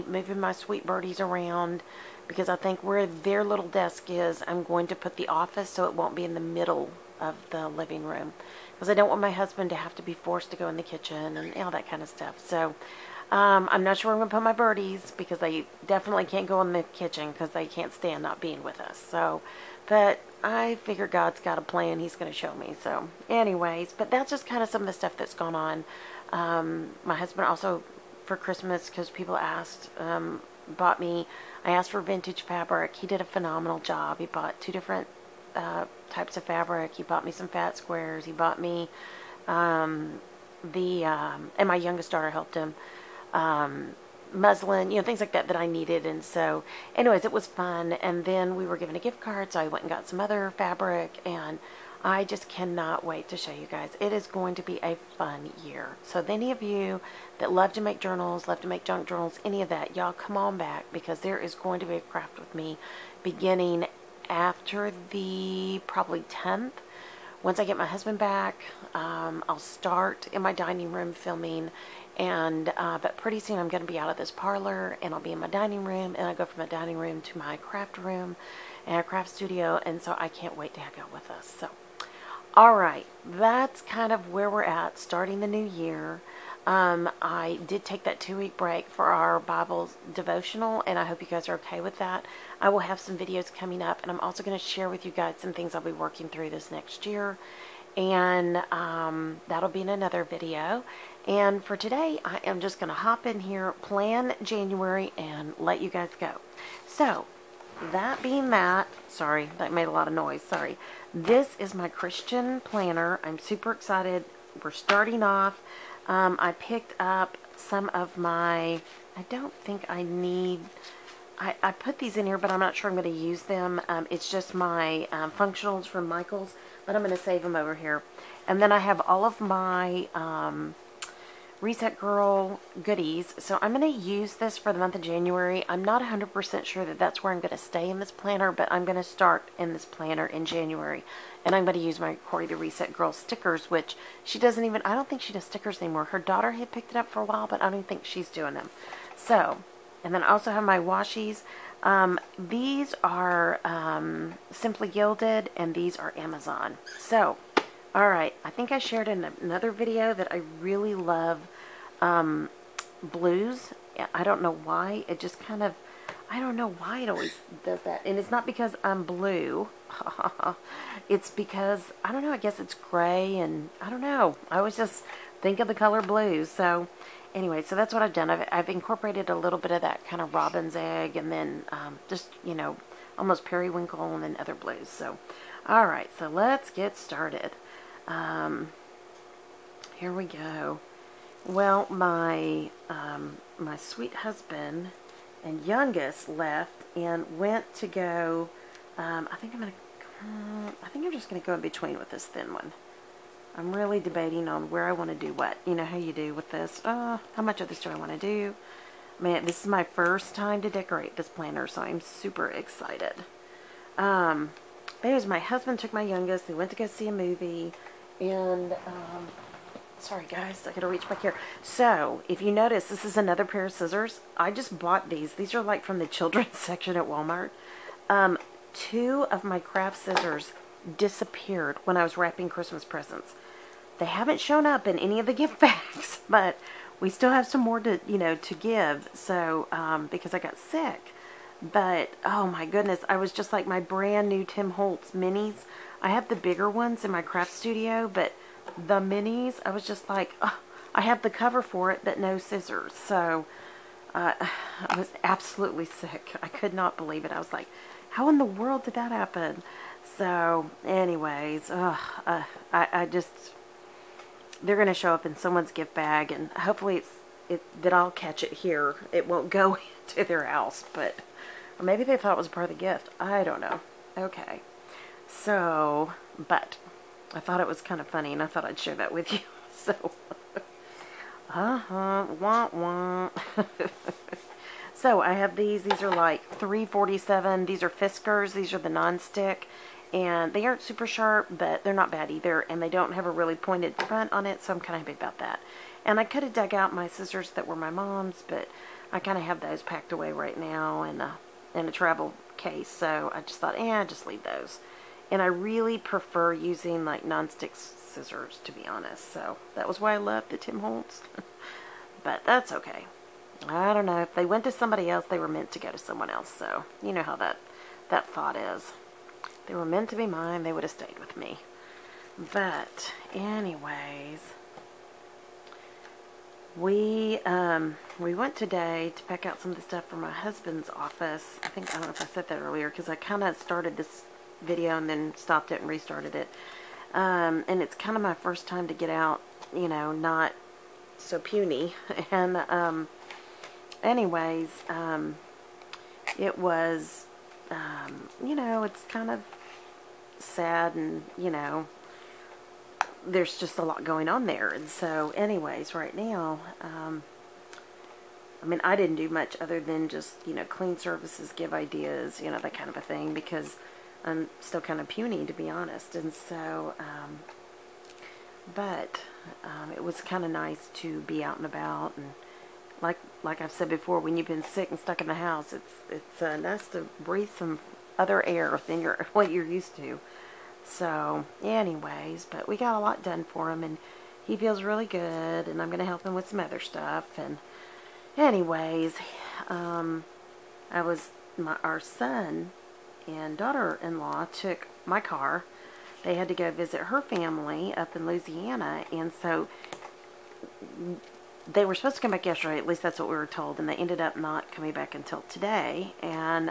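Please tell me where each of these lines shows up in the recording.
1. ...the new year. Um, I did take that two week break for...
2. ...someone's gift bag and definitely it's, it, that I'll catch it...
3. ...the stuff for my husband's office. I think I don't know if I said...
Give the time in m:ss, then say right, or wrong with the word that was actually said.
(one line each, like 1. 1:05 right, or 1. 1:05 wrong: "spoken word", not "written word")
1. 1:25 right
2. 4:25 wrong: "hopefully", not "definitely"
3. 5:29 right.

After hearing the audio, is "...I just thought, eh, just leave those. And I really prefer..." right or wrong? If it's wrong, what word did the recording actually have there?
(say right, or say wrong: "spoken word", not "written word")
right.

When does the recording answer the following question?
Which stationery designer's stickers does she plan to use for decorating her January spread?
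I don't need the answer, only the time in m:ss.
2:22.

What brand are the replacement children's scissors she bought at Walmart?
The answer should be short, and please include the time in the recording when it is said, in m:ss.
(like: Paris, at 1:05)
Fiskars, at 4:47.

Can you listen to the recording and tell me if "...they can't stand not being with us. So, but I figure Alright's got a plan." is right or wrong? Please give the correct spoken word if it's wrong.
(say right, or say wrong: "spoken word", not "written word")
wrong: "God", not "Alright".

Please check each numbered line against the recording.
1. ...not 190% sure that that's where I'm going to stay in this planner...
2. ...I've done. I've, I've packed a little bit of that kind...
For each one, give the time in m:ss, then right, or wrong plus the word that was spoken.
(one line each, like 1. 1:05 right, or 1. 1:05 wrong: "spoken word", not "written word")
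1. 2:15 wrong: "100", not "190"
2. 2:58 wrong: "incorporated", not "packed".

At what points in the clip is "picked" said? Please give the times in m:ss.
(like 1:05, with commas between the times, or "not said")
1:56, 2:26.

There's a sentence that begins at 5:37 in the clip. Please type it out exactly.
Um, and it's kind of my first time to get out, you know, not so puny.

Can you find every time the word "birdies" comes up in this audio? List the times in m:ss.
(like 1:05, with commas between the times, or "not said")
0:00, 0:14.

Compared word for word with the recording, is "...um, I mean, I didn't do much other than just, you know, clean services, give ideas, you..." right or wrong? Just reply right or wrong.
right.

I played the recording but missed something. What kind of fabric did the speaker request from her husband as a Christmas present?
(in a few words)
vintage fabric.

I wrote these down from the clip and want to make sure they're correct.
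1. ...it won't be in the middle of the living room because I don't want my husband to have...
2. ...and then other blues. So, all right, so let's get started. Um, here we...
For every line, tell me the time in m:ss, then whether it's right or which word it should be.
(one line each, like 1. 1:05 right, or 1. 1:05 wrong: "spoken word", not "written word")
1. 0:05 right
2. 3:04 right.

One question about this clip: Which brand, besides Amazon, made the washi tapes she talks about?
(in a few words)
Simply Gilded.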